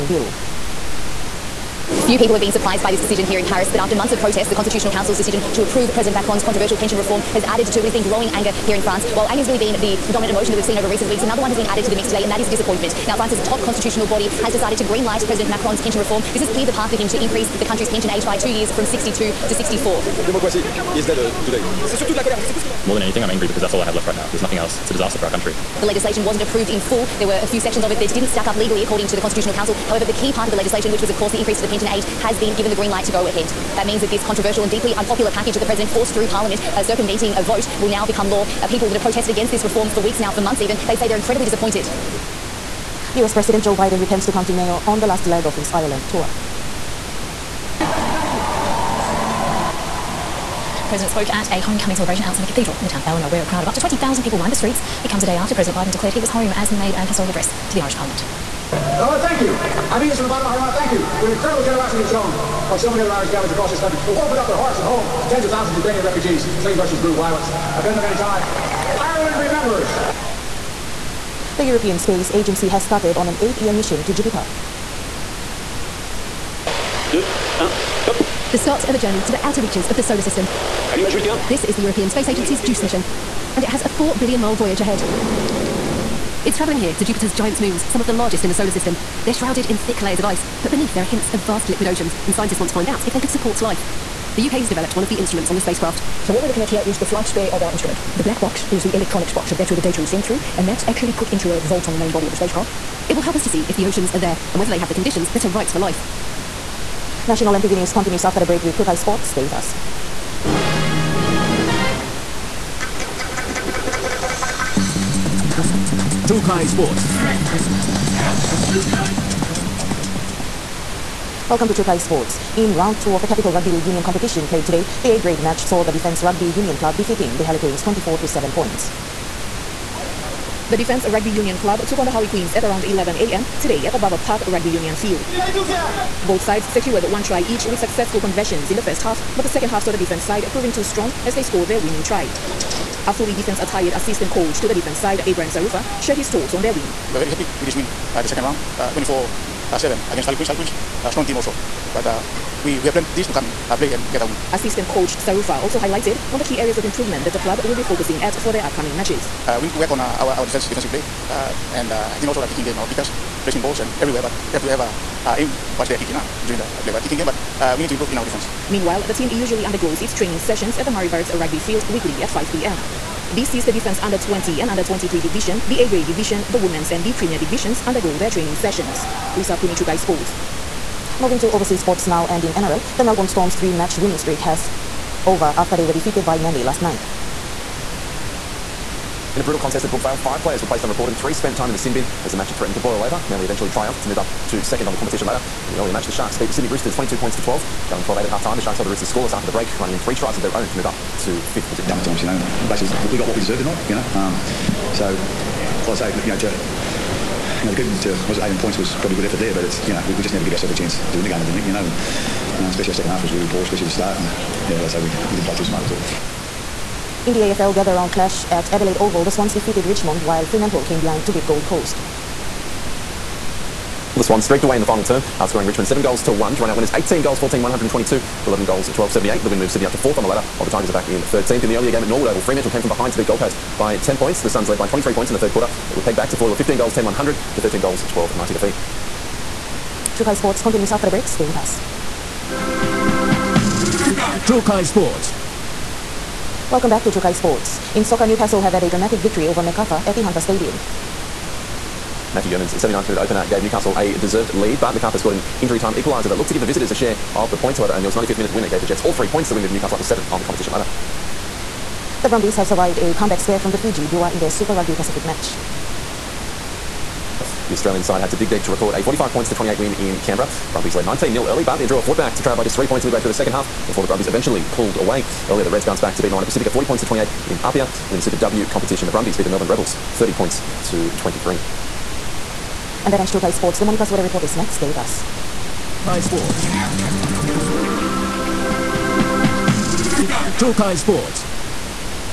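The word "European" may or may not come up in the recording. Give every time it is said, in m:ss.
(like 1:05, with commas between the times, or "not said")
1:11, 1:21.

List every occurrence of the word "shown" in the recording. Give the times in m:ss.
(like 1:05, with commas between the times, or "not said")
1:02.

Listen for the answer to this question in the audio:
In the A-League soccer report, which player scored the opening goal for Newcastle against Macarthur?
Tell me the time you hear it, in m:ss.
4:12.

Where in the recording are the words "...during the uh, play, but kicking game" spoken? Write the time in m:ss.
2:46.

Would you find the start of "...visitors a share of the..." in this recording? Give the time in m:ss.
4:16.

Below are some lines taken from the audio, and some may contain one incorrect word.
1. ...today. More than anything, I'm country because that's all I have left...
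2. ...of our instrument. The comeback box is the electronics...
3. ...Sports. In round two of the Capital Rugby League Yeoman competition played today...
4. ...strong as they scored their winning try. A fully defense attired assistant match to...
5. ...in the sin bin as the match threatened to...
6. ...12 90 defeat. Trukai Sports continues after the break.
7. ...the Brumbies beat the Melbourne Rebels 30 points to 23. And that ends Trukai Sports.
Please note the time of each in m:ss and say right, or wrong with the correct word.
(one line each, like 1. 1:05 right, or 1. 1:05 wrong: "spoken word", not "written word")
1. 0:21 wrong: "angry", not "country"
2. 1:37 wrong: "black", not "comeback"
3. 2:01 wrong: "Union", not "Yeoman"
4. 2:20 wrong: "coach", not "match"
5. 3:11 right
6. 3:58 right
7. 4:39 right.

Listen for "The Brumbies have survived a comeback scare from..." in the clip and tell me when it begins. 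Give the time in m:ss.
4:22.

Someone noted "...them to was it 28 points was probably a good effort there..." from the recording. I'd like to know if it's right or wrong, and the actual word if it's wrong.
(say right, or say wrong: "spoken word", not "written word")
wrong: "18", not "28".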